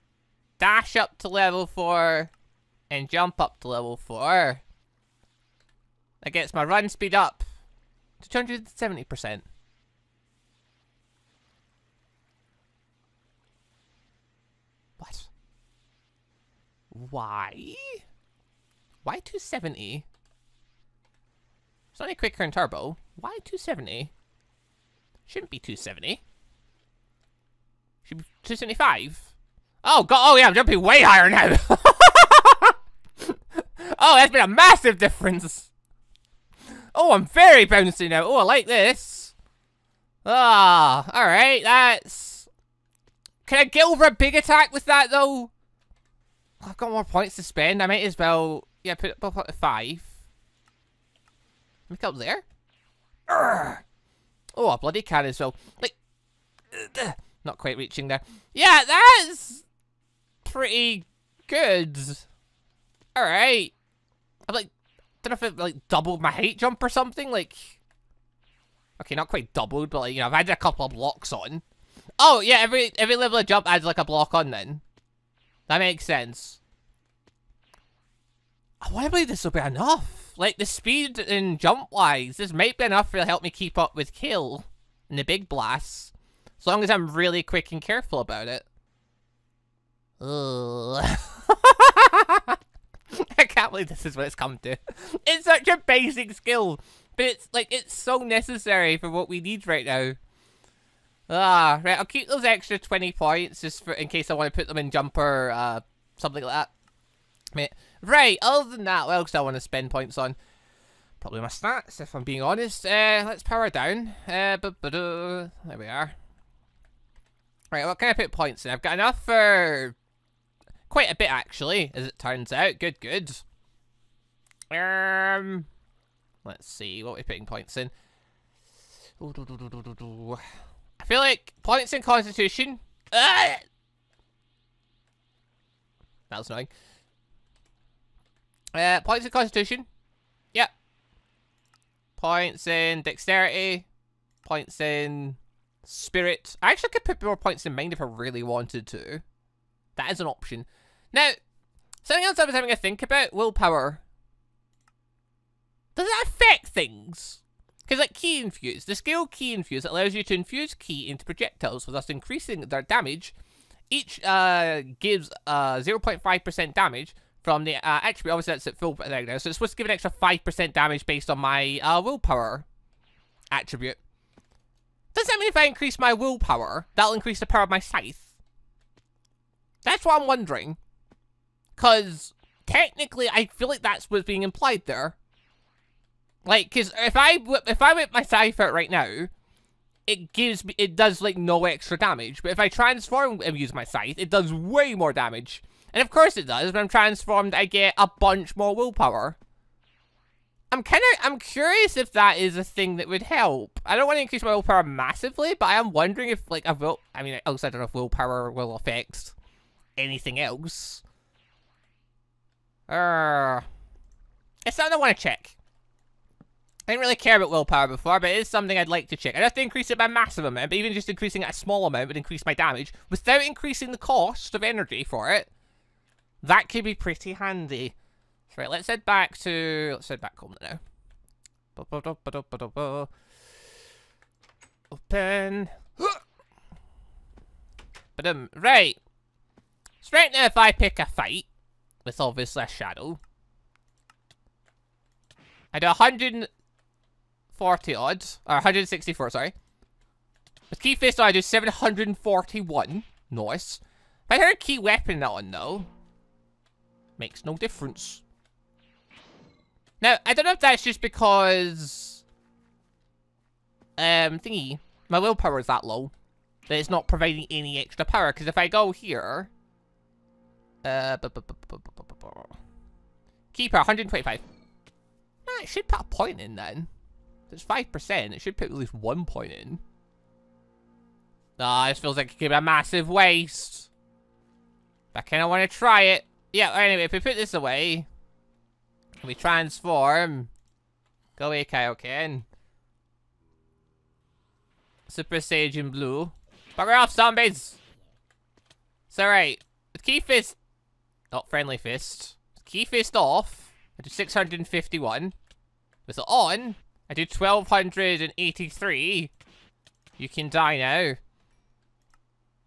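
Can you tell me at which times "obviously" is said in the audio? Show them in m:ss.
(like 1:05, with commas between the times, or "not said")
2:48, 4:02.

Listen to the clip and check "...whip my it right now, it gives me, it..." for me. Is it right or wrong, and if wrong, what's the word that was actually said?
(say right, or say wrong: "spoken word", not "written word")
right.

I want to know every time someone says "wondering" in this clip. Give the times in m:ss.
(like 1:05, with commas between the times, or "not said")
3:00, 3:25.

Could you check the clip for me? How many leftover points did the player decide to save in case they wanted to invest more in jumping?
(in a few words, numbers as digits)
20.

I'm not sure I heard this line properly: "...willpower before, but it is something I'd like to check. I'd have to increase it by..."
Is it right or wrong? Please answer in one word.
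right.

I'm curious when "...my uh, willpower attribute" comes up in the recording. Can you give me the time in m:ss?
2:51.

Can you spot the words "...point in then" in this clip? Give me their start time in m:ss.
4:36.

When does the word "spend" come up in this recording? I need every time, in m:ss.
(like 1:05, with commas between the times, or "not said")
0:47, 1:49.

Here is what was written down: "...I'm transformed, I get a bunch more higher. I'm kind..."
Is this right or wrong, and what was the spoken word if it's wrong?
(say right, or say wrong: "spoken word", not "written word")
wrong: "willpower", not "higher".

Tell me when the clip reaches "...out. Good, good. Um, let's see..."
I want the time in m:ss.
2:02.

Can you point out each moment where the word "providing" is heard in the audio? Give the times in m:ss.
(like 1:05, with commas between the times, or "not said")
4:27.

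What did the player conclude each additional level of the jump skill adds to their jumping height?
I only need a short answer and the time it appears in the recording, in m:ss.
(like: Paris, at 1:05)
a block, at 1:13.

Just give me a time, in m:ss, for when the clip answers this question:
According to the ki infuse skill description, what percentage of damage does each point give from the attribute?
2:45.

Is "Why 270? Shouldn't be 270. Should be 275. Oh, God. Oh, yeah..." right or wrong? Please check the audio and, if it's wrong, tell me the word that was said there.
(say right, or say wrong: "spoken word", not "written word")
right.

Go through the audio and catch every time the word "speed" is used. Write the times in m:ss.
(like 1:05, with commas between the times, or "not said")
0:06, 1:20.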